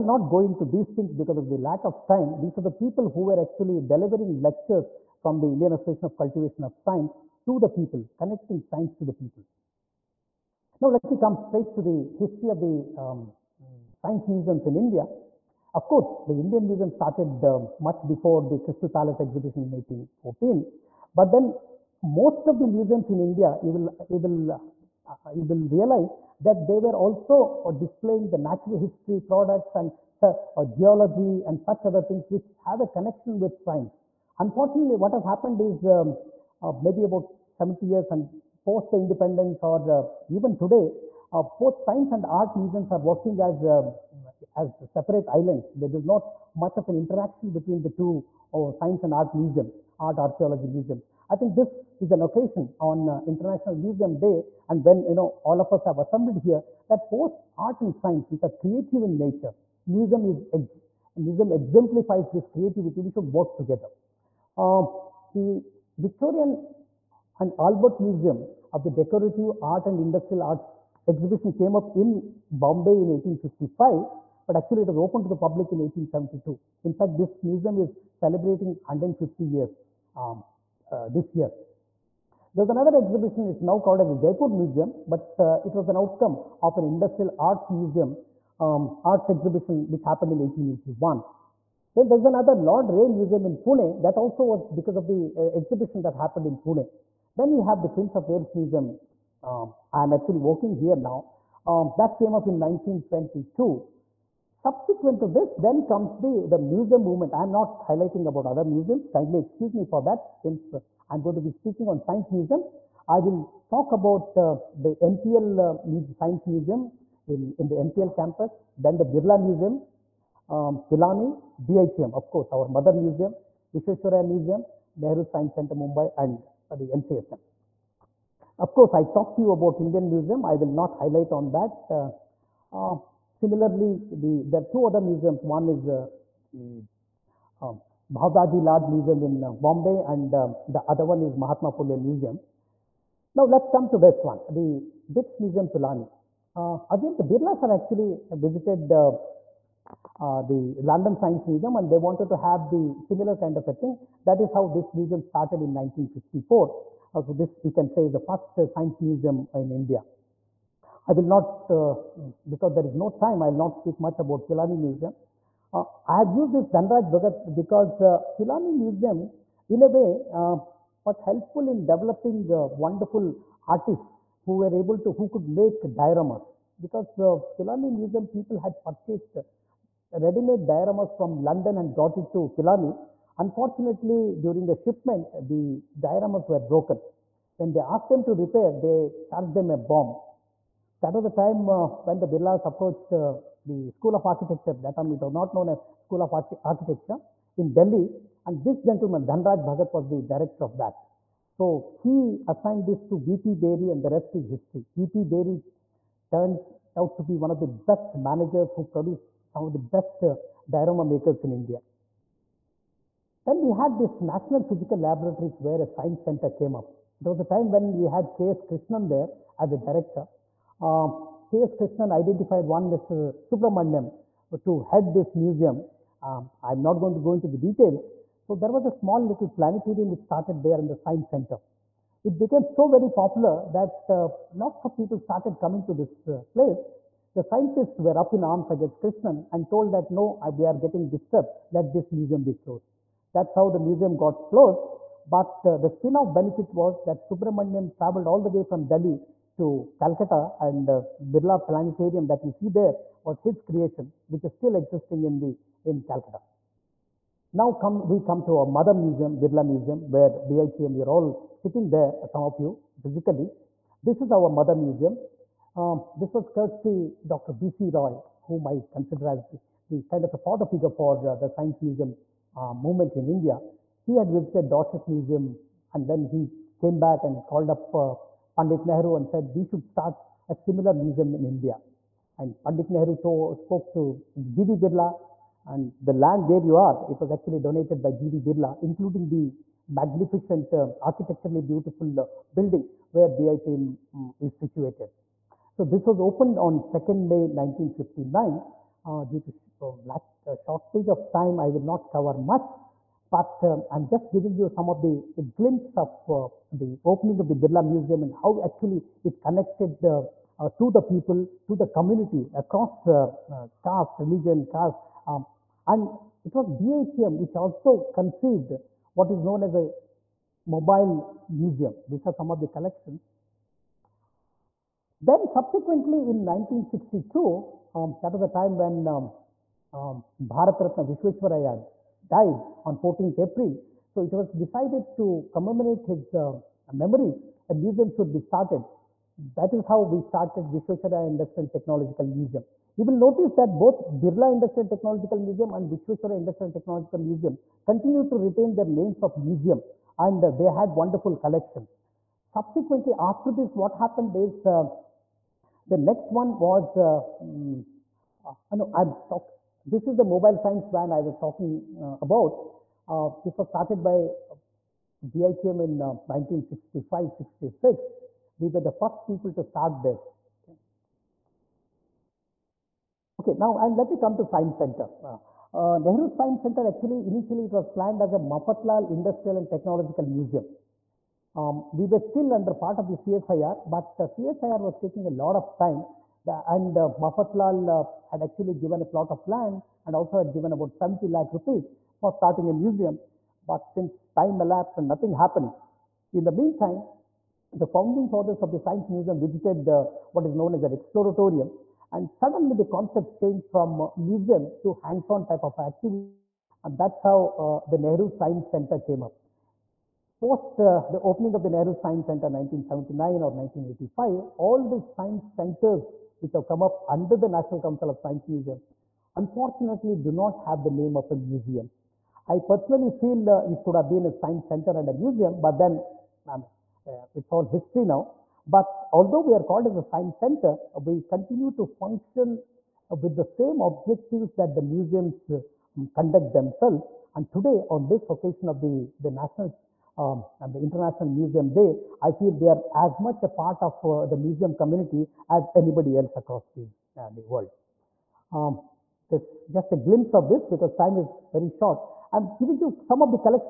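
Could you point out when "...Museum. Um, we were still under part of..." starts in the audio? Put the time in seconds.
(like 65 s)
380 s.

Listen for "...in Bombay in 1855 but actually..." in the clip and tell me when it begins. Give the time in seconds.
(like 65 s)
71 s.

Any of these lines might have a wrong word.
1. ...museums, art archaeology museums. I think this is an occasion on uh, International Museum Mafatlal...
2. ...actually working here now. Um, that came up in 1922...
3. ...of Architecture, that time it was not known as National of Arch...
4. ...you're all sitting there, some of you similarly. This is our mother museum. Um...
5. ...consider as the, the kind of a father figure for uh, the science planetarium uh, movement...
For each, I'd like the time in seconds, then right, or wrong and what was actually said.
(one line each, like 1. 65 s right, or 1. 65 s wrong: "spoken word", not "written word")
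1. 49 s wrong: "Day", not "Mafatlal"
2. 100 s right
3. 194 s wrong: "School", not "National"
4. 260 s wrong: "physically", not "similarly"
5. 268 s wrong: "museum", not "planetarium".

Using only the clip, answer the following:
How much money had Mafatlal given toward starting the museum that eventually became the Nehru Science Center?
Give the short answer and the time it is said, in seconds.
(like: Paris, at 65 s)
70 lakh rupees, at 390 s.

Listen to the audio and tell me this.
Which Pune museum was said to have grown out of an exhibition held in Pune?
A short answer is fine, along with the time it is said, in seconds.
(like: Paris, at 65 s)
Lord Reay Museum, at 92 s.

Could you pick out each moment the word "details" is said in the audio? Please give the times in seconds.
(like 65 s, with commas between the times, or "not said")
227 s.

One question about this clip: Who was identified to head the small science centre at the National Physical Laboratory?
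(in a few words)
Mr. Subramaniam.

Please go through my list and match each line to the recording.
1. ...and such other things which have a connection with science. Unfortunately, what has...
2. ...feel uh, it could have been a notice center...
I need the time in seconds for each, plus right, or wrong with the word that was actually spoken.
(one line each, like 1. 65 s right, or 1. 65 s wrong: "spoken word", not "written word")
1. 31 s right
2. 423 s wrong: "science", not "notice".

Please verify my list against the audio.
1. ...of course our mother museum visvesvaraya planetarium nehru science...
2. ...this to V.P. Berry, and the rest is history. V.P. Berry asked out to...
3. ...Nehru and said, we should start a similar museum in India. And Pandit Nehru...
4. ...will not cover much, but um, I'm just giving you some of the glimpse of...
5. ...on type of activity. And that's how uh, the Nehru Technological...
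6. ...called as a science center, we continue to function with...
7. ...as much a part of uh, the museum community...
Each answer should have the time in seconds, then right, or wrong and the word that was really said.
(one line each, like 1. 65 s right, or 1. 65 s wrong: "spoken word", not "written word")
1. 122 s wrong: "museum", not "planetarium"
2. 202 s wrong: "turned", not "asked"
3. 278 s right
4. 301 s right
5. 405 s wrong: "Science", not "Technological"
6. 429 s right
7. 442 s right.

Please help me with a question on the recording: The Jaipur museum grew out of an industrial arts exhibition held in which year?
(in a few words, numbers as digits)
1881.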